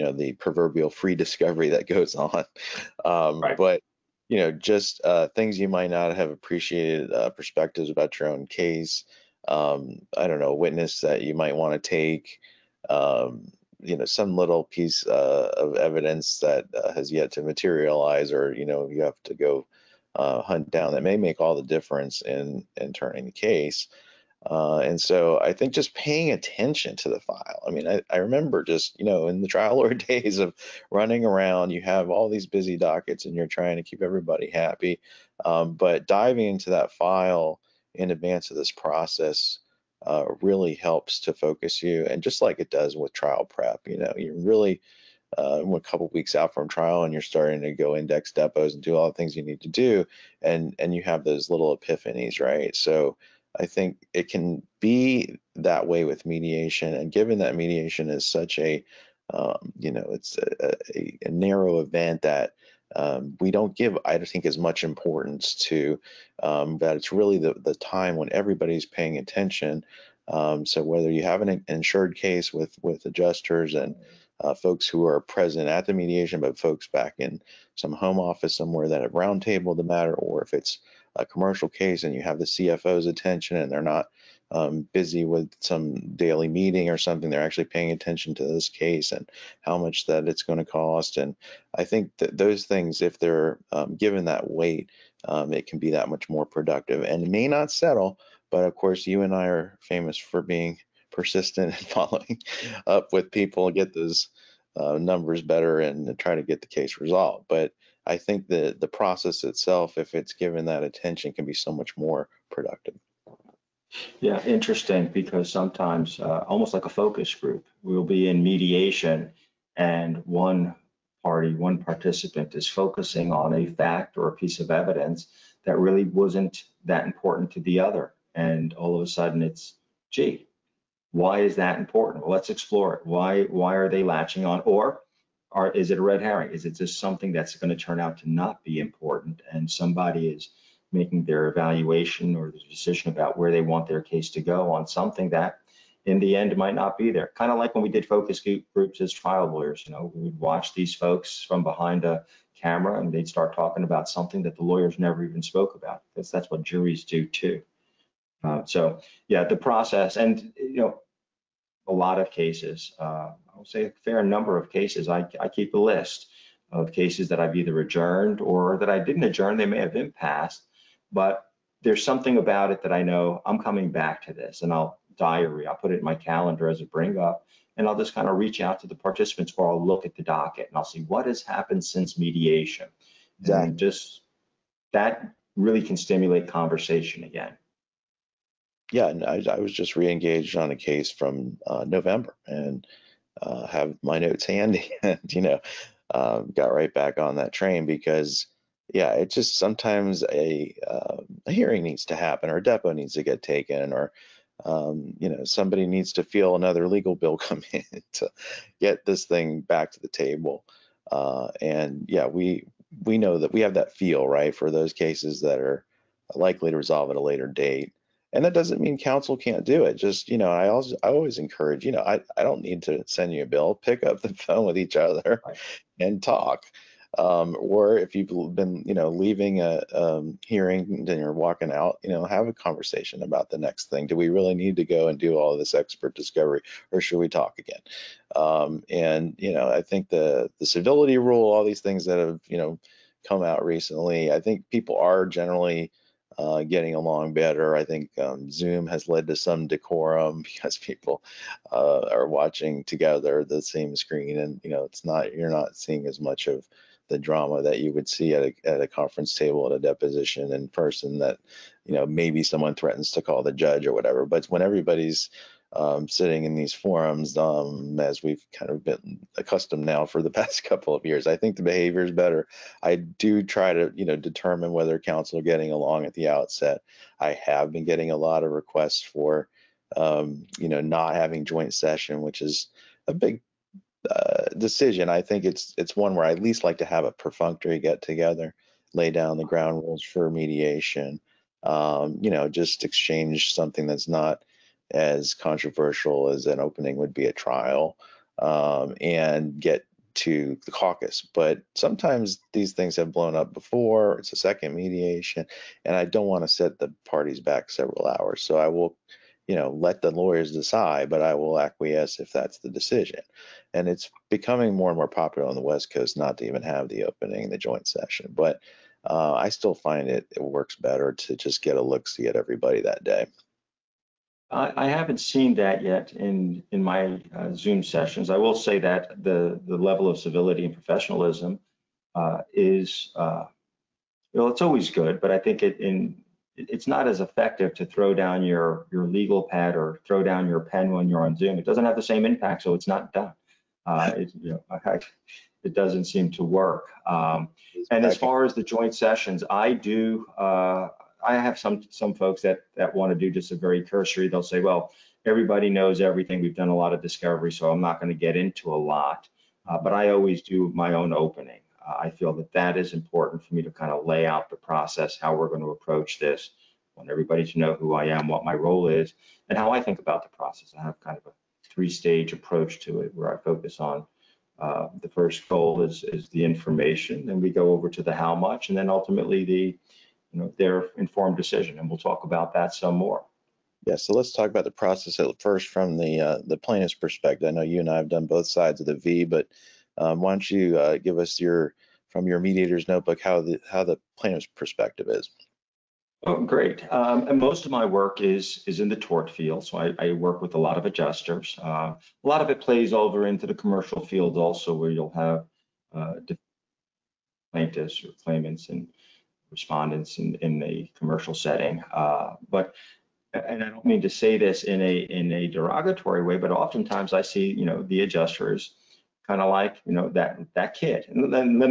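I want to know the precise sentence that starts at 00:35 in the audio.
Um, but diving into that file in advance of this process uh, really helps to focus you.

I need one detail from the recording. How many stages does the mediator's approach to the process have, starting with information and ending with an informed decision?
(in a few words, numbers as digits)
3.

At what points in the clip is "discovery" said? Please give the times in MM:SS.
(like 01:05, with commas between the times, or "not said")
00:01, 03:56, 05:57.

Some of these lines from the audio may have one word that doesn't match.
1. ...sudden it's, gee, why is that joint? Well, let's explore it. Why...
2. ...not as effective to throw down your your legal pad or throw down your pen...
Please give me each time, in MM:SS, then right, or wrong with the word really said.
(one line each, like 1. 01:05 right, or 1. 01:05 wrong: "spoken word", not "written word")
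1. 02:09 wrong: "important", not "joint"
2. 05:36 right.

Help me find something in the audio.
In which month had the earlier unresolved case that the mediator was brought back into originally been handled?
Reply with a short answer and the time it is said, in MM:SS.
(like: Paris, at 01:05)
November, at 03:11.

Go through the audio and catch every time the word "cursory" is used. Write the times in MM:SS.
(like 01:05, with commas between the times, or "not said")
05:53.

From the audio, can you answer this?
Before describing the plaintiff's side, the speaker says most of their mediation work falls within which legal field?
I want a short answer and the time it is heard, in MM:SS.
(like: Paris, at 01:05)
tort, at 06:38.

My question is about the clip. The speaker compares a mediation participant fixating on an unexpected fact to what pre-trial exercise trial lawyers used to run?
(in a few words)
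focus groups.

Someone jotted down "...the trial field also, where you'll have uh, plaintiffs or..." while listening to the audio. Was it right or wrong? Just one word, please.
wrong.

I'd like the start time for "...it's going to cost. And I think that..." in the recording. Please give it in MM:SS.
01:30.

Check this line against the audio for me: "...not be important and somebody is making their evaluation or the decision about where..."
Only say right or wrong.
right.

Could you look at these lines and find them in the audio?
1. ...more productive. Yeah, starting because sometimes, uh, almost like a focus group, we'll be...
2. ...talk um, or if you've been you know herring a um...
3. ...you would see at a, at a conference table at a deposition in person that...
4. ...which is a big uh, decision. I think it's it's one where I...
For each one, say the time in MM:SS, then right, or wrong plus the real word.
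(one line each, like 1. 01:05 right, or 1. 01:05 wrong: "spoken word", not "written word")
1. 01:51 wrong: "interesting", not "starting"
2. 03:46 wrong: "leaving", not "herring"
3. 04:17 right
4. 04:42 right.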